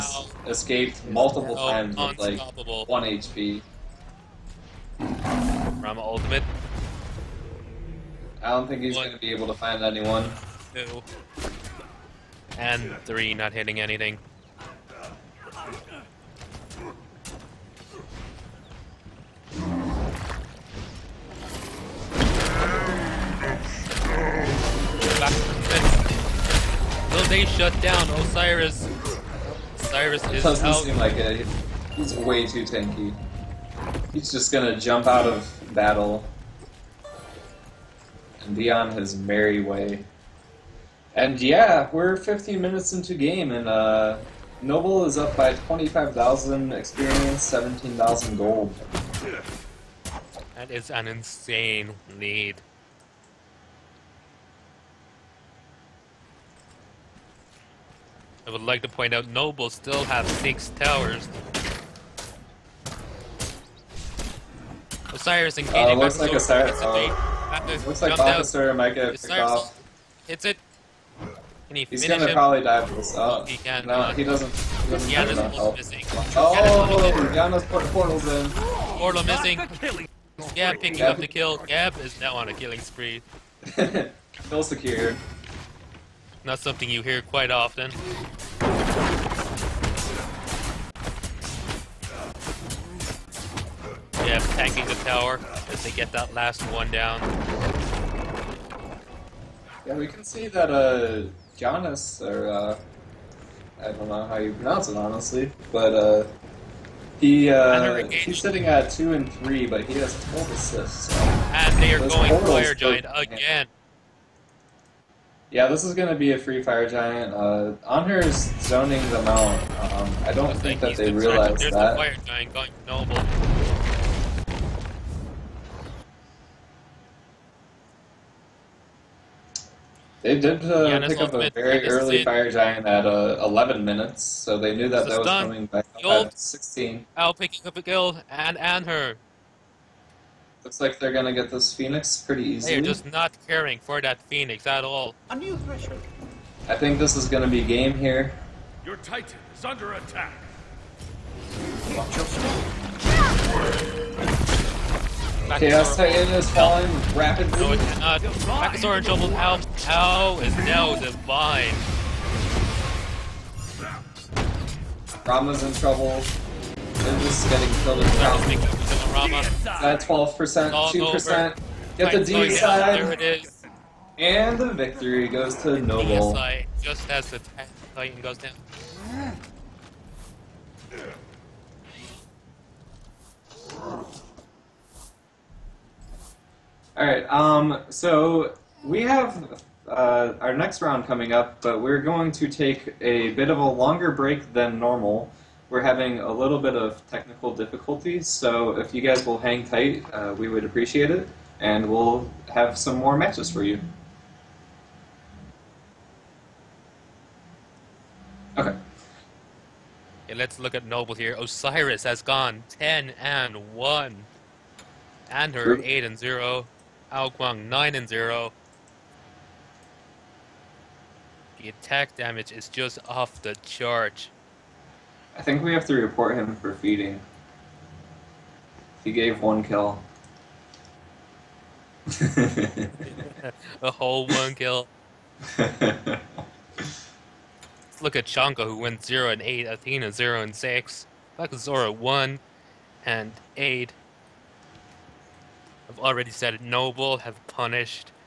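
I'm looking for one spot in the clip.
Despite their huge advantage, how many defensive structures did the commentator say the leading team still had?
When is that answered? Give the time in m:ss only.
1:00.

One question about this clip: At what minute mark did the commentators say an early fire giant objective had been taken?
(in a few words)
11.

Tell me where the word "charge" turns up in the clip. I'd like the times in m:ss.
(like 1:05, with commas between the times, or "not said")
3:43.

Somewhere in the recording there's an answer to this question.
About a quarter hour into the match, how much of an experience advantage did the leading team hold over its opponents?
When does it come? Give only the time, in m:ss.
0:45.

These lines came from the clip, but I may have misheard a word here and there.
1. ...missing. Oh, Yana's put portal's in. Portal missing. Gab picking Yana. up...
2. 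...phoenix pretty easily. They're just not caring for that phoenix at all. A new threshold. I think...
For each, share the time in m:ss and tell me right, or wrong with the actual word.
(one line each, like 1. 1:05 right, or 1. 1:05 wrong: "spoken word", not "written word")
1. 1:15 wrong: "Gab", not "Yana"
2. 2:21 right.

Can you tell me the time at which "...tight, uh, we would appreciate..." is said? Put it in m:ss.
3:19.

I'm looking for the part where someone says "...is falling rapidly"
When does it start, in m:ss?
2:36.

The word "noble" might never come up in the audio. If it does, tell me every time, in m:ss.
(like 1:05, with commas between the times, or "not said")
0:44, 0:59, 2:02, 2:55, 3:30, 4:06.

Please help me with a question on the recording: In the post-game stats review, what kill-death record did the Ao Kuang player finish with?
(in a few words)
9 and 0.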